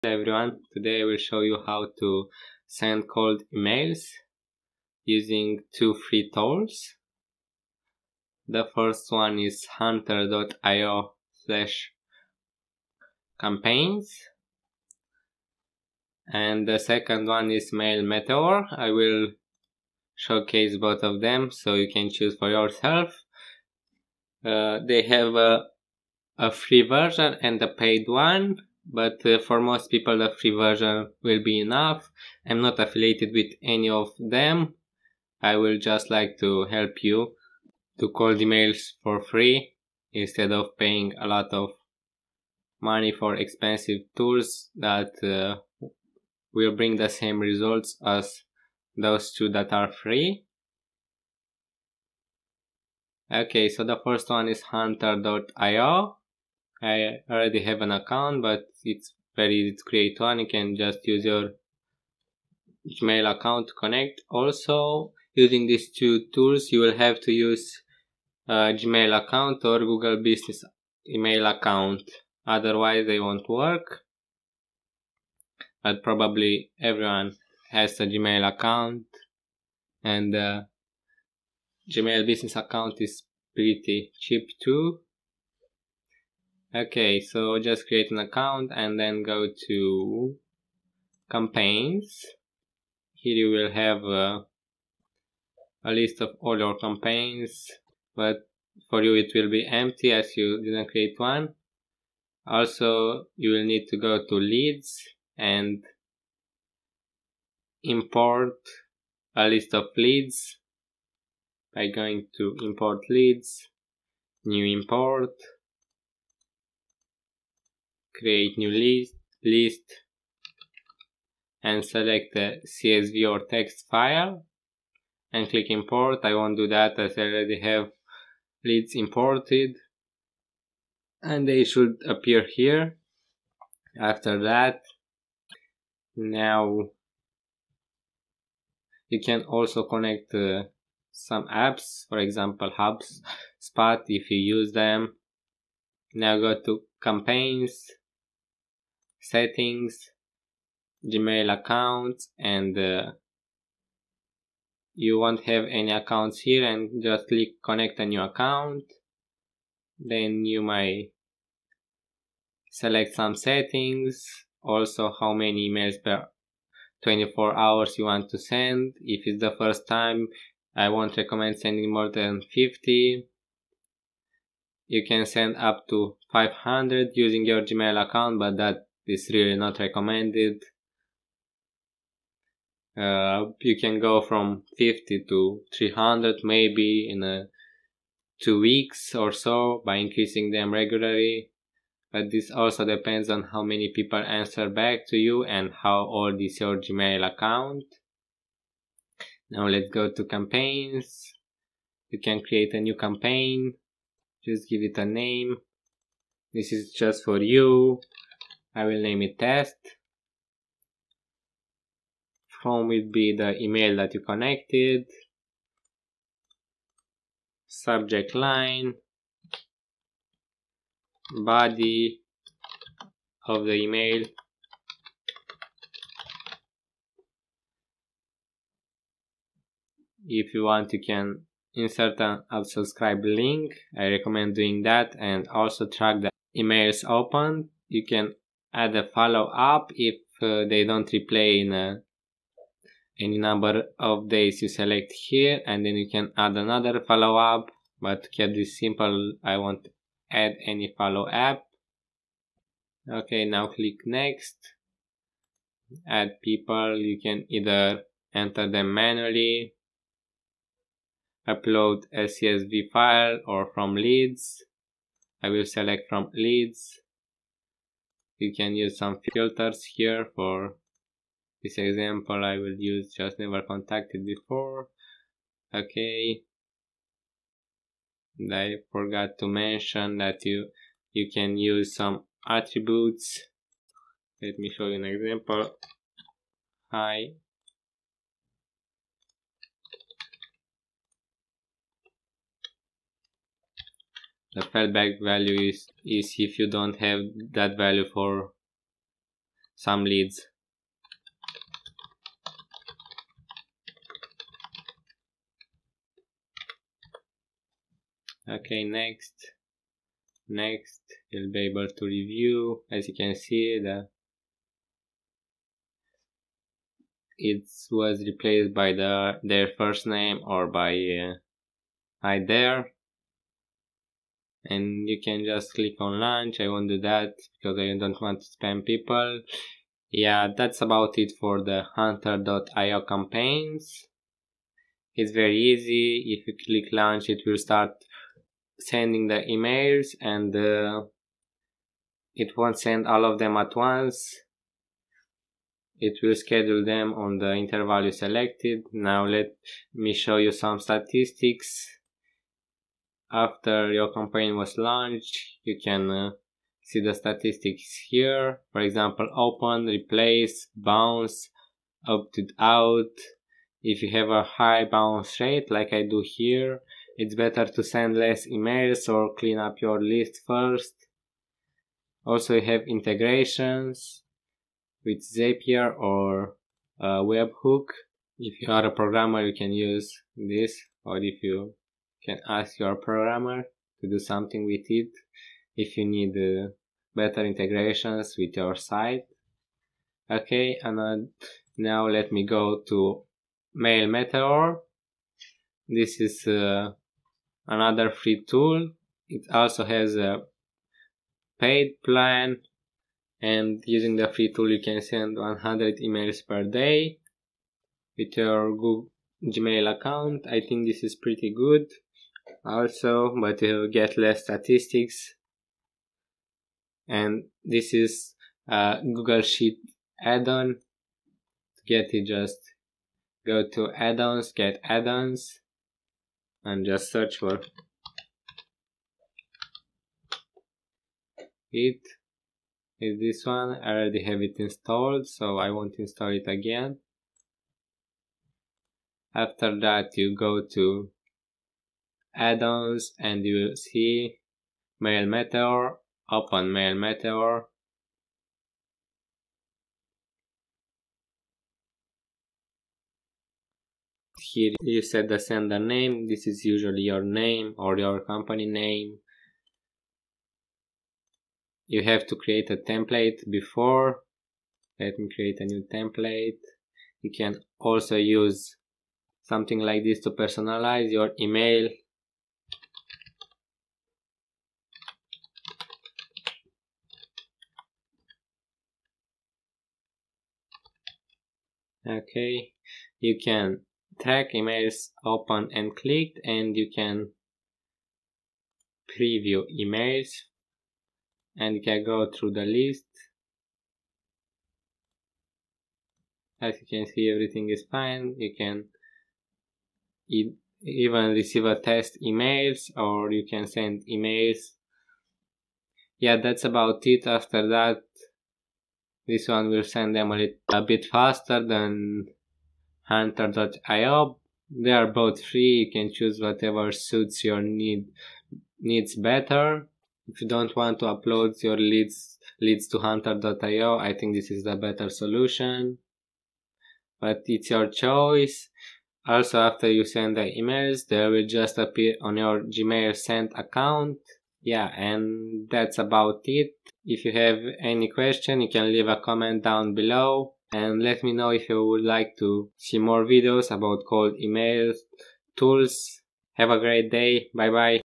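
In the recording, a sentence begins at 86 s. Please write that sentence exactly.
Okay, so just create an account and then go to campaigns.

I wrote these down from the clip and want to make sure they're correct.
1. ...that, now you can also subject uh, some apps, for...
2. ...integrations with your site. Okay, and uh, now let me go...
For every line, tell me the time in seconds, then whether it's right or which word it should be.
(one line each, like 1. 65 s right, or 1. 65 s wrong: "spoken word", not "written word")
1. 134 s wrong: "connect", not "subject"
2. 387 s right.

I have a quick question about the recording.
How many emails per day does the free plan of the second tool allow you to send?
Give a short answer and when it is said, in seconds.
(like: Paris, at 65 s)
100, at 405 s.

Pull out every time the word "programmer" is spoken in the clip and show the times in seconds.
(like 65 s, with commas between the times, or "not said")
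378 s, 382 s.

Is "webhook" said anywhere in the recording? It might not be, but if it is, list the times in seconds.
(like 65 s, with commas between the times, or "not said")
377 s.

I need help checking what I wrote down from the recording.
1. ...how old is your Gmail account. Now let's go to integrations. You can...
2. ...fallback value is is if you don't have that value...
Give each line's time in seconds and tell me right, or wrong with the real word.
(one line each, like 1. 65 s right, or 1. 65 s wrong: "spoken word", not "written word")
1. 195 s wrong: "campaigns", not "integrations"
2. 294 s right.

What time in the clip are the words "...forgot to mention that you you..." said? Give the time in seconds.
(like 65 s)
278 s.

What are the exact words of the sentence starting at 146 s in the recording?
Now go to campaigns settings, Gmail accounts and uh, you won't have any accounts here and just click connect a new account.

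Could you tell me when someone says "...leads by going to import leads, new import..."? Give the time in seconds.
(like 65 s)
109 s.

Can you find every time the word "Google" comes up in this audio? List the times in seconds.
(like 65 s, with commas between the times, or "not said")
69 s, 408 s, 419 s.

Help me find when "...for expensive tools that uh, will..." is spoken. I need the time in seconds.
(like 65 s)
43 s.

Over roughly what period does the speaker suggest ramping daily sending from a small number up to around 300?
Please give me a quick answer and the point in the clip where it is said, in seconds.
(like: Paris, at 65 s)
Two weeks, at 188 s.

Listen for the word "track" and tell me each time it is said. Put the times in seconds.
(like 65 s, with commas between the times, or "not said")
235 s, 484 s.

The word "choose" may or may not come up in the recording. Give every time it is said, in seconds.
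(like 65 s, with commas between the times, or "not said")
22 s, 516 s.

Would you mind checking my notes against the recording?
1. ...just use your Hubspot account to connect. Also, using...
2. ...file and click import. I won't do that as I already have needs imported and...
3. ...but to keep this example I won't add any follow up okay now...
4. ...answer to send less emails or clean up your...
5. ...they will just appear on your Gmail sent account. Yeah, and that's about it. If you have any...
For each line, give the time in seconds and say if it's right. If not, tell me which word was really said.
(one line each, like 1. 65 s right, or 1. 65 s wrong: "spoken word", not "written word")
1. 60 s wrong: "Gmail", not "Hubspot"
2. 123 s wrong: "leads", not "needs"
3. 248 s wrong: "simple", not "example"
4. 367 s wrong: "better", not "answer"
5. 531 s right.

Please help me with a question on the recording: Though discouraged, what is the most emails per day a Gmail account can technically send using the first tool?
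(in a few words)
500.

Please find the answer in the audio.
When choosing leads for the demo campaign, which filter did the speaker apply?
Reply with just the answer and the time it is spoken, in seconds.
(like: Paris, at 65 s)
Never contacted before, at 273 s.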